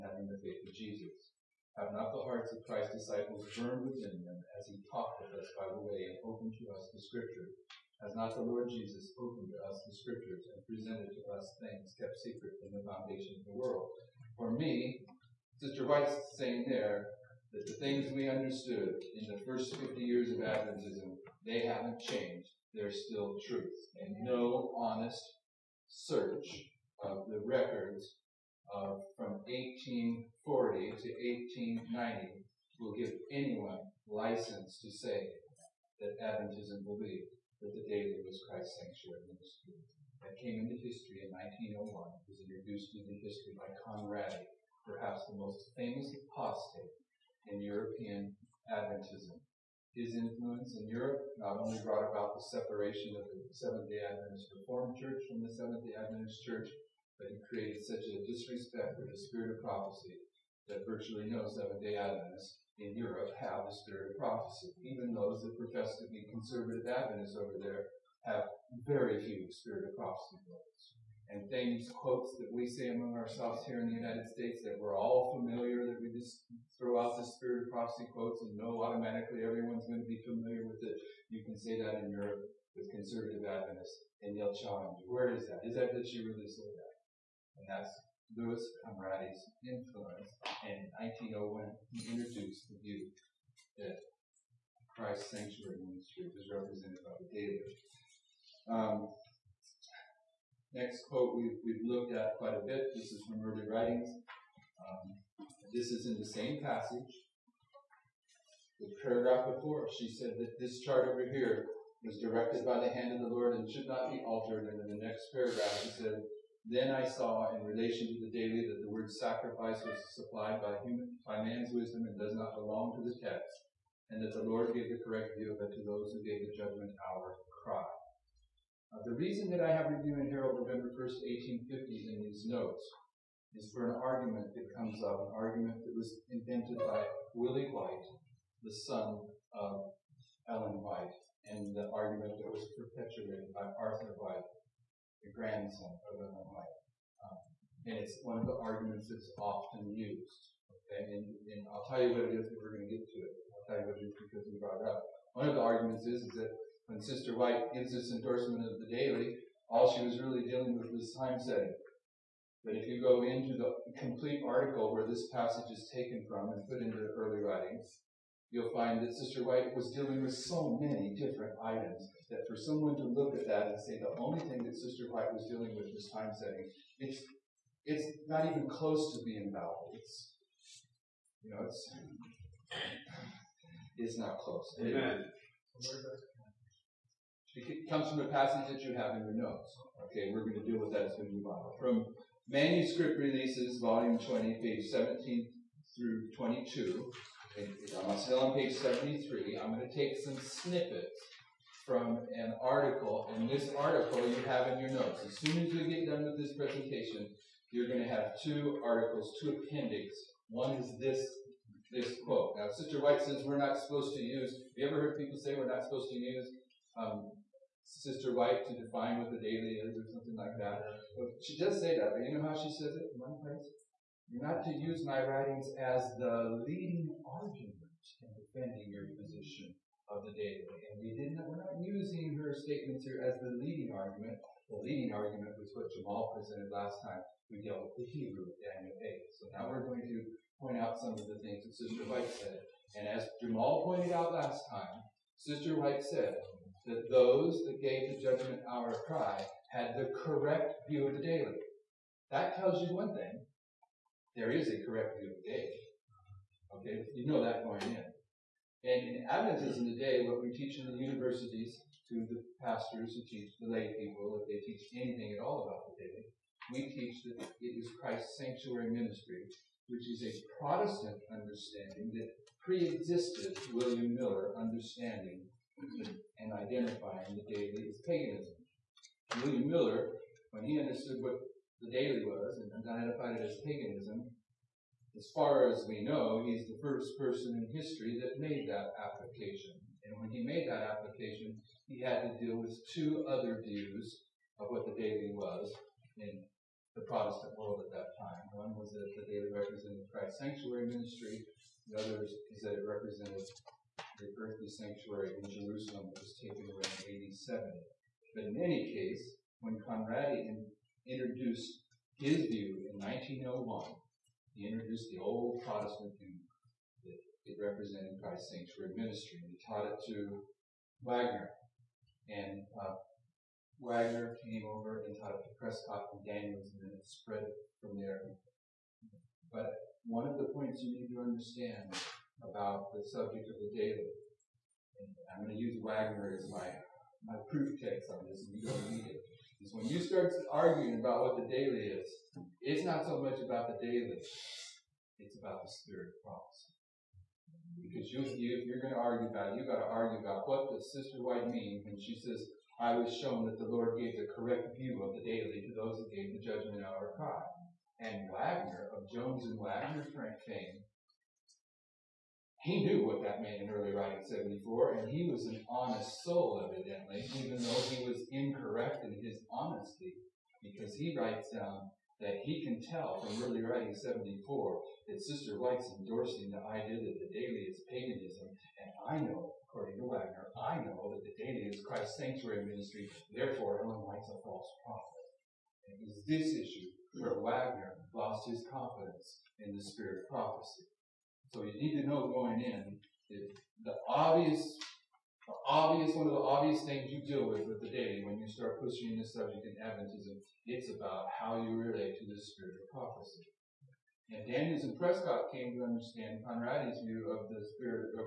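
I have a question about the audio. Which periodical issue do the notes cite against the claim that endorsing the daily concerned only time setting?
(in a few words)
Review and Herald November 1st, 1850.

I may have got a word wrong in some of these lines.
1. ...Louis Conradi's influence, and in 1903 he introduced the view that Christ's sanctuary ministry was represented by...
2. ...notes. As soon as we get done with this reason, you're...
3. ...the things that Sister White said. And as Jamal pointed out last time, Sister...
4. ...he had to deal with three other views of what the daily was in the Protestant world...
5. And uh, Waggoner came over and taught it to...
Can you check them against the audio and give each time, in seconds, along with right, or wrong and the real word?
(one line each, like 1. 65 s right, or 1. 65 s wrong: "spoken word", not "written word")
1. 88 s wrong: "1901", not "1903"
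2. 204 s wrong: "presentation", not "reason"
3. 241 s right
4. 291 s wrong: "two", not "three"
5. 322 s right.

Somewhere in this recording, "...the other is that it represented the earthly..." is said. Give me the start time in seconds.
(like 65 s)
301 s.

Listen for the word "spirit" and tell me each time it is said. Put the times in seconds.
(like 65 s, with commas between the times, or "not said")
59 s, 63 s, 69 s, 77 s, 345 s, 389 s, 402 s, 407 s.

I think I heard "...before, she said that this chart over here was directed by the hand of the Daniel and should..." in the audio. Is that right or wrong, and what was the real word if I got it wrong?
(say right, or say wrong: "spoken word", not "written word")
wrong: "Lord", not "Daniel".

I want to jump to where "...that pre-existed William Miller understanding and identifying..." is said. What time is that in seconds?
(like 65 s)
272 s.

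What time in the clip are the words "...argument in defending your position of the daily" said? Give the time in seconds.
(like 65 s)
227 s.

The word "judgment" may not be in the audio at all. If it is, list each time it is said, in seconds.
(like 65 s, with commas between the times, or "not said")
126 s, 248 s, 356 s.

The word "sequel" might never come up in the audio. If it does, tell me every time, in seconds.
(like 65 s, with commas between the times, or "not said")
not said.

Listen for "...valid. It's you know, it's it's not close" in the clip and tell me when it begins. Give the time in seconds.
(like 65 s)
179 s.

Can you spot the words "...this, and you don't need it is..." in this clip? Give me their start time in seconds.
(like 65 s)
338 s.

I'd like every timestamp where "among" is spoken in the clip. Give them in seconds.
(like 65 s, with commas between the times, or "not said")
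72 s.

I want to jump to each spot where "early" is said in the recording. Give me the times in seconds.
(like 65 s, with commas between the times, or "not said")
103 s, 167 s, 363 s, 373 s.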